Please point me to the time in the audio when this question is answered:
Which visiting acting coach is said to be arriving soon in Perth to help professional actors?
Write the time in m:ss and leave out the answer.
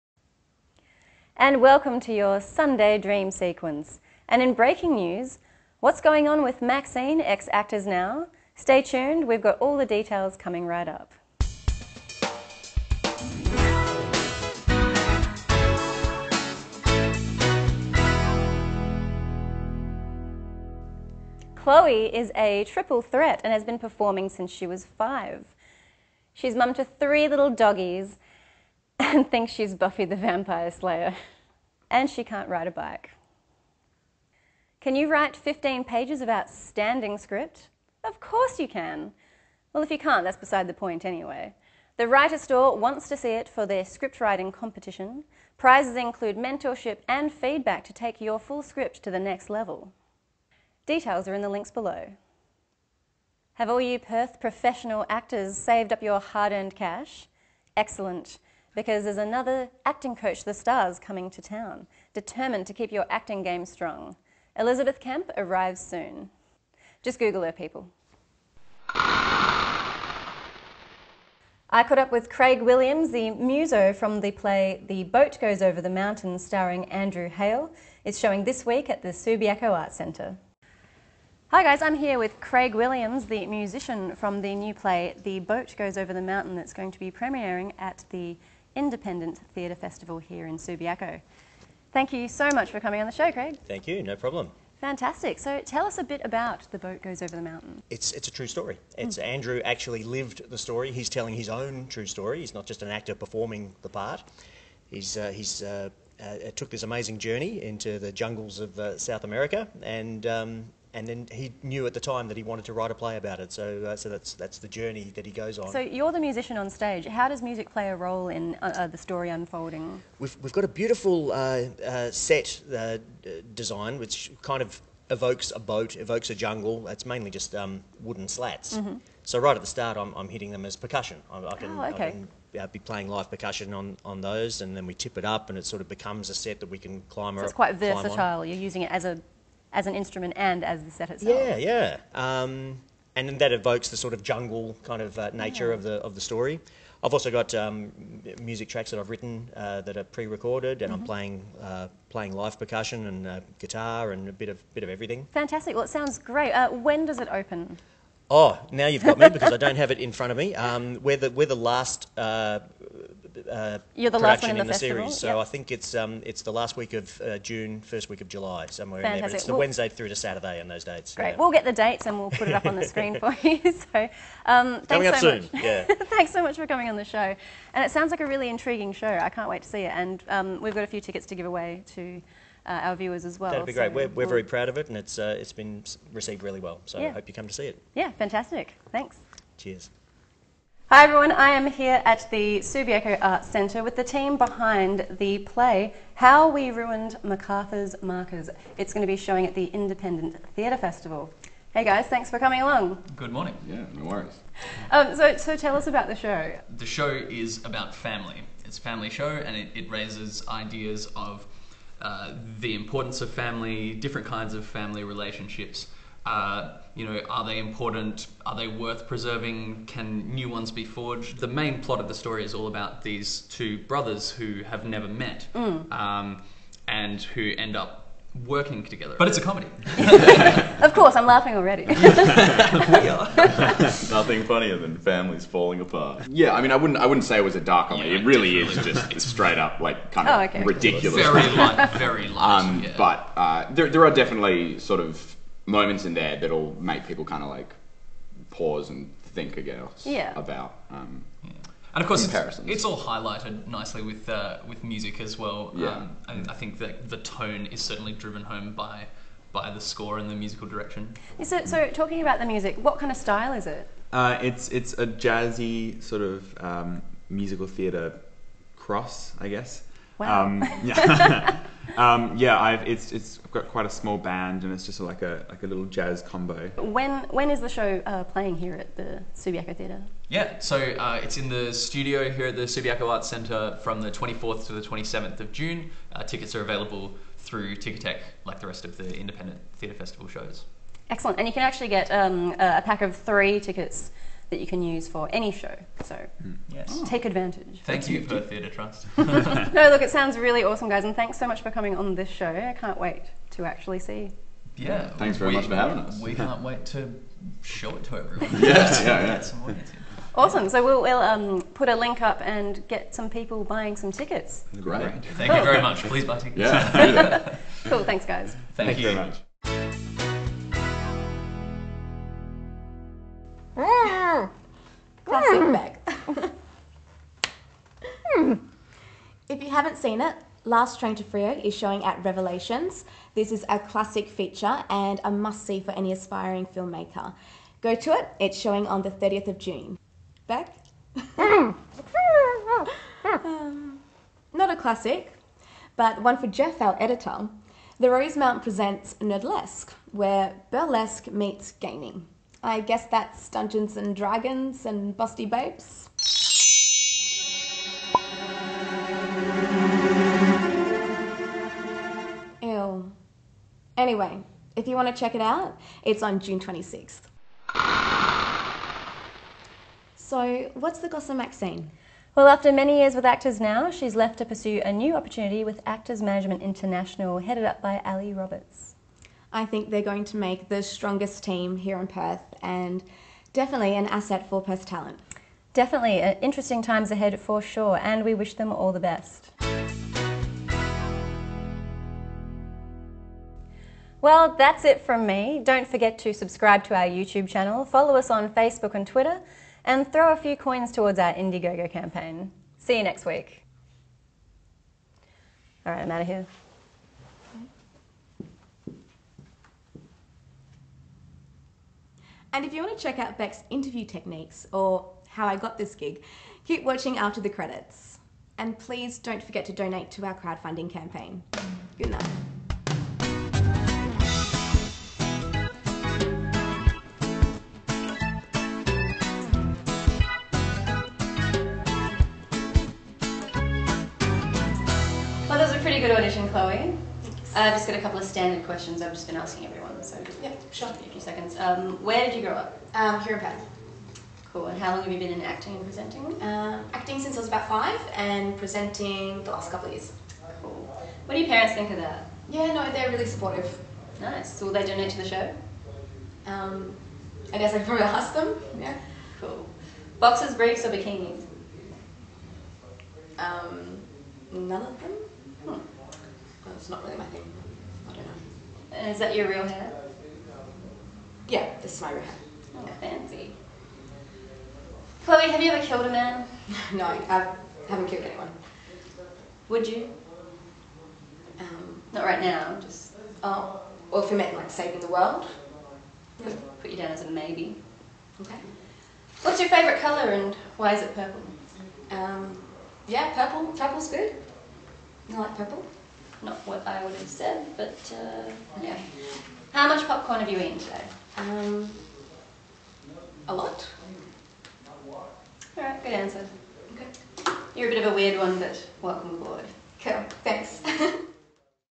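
1:04.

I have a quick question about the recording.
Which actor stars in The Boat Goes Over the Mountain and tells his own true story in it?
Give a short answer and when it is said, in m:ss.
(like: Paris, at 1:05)
Andrew Hale, at 1:16.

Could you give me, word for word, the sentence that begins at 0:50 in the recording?
Details are in the links below.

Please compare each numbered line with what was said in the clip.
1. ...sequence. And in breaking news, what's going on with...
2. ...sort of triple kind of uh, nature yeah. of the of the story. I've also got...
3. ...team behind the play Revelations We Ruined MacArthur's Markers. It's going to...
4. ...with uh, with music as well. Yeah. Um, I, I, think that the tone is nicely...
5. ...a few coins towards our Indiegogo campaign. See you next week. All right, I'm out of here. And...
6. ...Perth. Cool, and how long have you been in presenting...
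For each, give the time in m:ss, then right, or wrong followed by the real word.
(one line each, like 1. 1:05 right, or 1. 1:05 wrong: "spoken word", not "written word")
1. 0:03 right
2. 2:23 wrong: "jungle", not "triple"
3. 3:14 wrong: "How", not "Revelations"
4. 4:14 wrong: "certainly", not "nicely"
5. 6:40 right
6. 7:23 wrong: "acting", not "presenting".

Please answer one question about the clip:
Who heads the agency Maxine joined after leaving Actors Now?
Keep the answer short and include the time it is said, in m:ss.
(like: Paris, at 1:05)
Ali Roberts, at 6:18.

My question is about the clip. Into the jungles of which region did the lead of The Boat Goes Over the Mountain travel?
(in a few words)
South America.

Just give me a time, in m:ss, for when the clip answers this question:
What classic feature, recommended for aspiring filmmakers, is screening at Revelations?
5:30.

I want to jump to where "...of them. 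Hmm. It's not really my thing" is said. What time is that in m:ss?
7:44.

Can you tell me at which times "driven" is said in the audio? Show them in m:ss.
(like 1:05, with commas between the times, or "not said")
4:18.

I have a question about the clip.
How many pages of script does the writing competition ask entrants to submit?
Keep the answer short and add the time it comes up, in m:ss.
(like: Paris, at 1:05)
15, at 0:35.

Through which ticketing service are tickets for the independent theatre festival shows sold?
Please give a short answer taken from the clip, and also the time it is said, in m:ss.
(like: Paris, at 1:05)
Ticketek, at 4:47.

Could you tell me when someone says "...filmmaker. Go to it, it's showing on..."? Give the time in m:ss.
5:36.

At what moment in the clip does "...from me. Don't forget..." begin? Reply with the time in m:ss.
6:35.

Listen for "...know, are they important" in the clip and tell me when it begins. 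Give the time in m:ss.
3:37.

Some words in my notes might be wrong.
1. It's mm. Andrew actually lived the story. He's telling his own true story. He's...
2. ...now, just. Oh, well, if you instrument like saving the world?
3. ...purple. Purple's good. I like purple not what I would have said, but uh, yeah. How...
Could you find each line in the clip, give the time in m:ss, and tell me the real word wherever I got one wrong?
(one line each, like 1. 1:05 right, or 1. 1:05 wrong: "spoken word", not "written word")
1. 1:39 right
2. 8:02 wrong: "meant", not "instrument"
3. 8:13 right.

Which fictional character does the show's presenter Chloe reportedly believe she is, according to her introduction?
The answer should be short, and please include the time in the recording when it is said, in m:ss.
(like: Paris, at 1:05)
Buffy the Vampire Slayer, at 0:29.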